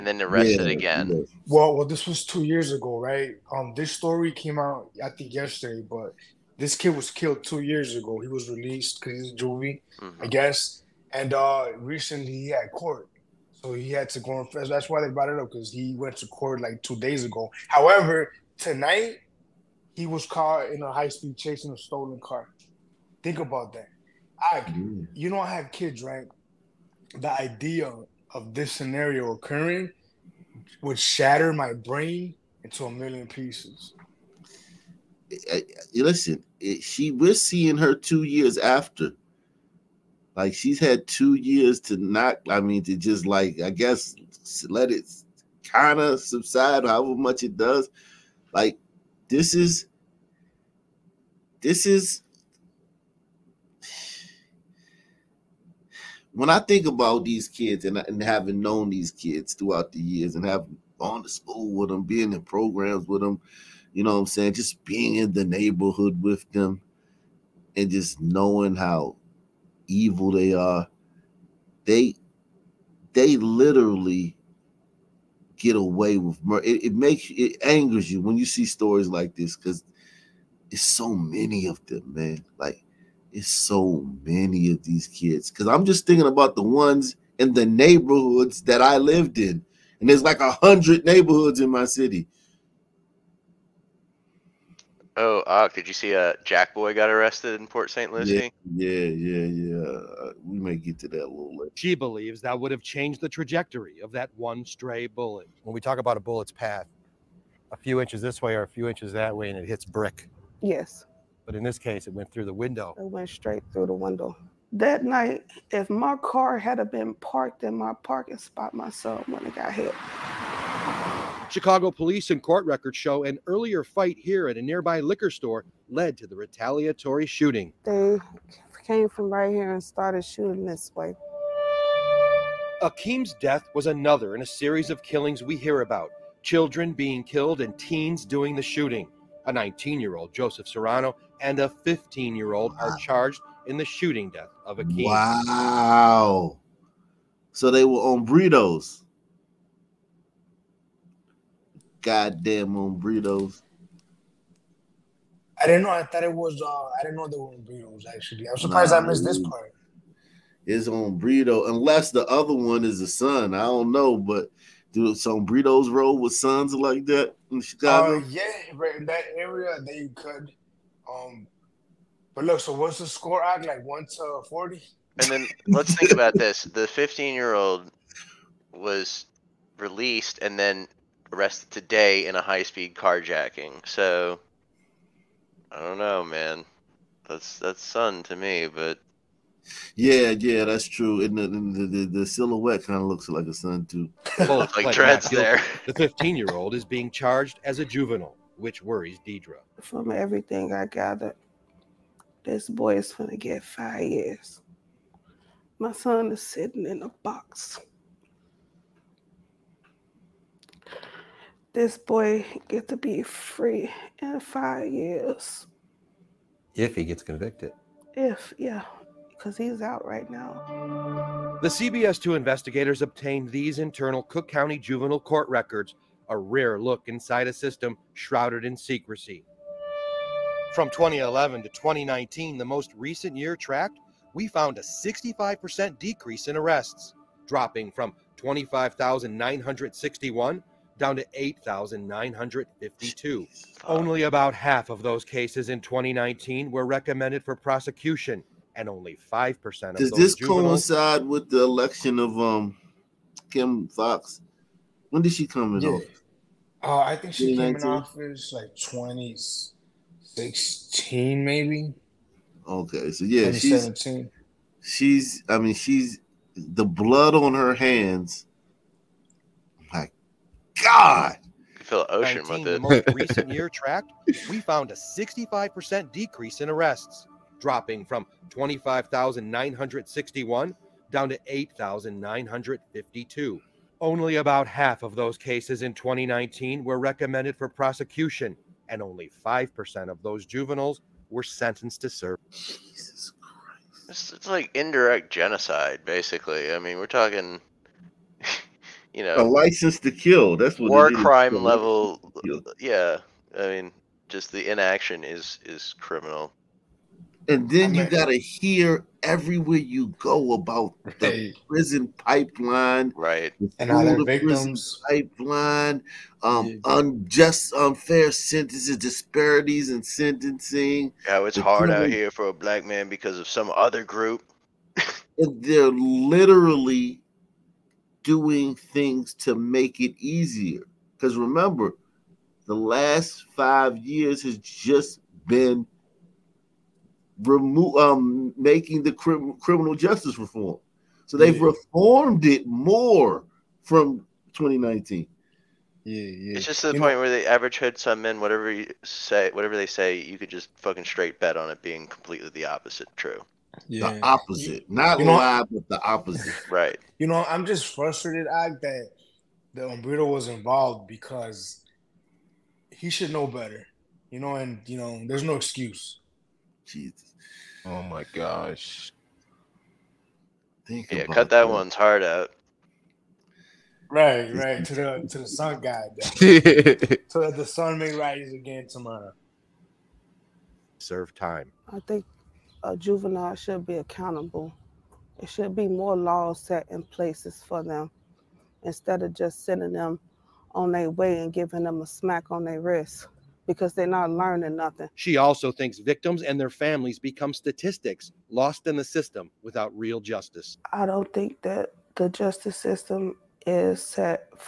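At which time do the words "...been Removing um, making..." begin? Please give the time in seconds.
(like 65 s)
335 s.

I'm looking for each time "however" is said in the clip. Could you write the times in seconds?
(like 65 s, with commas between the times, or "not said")
17 s, 46 s.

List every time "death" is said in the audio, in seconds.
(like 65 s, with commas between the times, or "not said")
133 s, 144 s.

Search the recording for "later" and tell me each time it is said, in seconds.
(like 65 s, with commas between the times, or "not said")
101 s.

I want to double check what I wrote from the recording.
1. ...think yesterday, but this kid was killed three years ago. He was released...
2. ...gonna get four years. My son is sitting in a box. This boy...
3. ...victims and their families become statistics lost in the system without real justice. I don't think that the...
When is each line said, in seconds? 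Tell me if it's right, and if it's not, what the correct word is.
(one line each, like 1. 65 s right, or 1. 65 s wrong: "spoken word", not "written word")
1. 5 s wrong: "two", not "three"
2. 203 s wrong: "five", not "four"
3. 395 s right.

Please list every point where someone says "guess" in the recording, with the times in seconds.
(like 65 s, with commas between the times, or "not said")
10 s, 43 s.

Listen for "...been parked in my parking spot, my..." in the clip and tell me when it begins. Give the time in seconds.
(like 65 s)
116 s.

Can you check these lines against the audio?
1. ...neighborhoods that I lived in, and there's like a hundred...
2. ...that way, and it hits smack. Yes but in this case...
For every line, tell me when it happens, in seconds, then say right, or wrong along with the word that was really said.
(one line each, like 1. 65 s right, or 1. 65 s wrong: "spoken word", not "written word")
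1. 87 s right
2. 109 s wrong: "brick", not "smack".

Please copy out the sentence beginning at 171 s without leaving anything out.
Um, but look, so what's the score?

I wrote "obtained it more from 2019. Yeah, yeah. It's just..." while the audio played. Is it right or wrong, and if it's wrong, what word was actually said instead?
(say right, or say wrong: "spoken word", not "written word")
wrong: "reformed", not "obtained".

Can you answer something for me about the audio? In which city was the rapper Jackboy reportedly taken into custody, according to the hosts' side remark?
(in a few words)
Port St. Lucie.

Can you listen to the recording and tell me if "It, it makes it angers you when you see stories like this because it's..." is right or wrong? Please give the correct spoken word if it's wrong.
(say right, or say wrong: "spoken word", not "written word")
right.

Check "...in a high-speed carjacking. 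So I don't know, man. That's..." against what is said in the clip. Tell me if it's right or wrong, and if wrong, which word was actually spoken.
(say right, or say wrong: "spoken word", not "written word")
right.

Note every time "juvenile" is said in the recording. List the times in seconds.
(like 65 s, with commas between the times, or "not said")
197 s, 224 s, 250 s, 290 s, 382 s.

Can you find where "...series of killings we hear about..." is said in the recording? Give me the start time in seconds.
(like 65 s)
134 s.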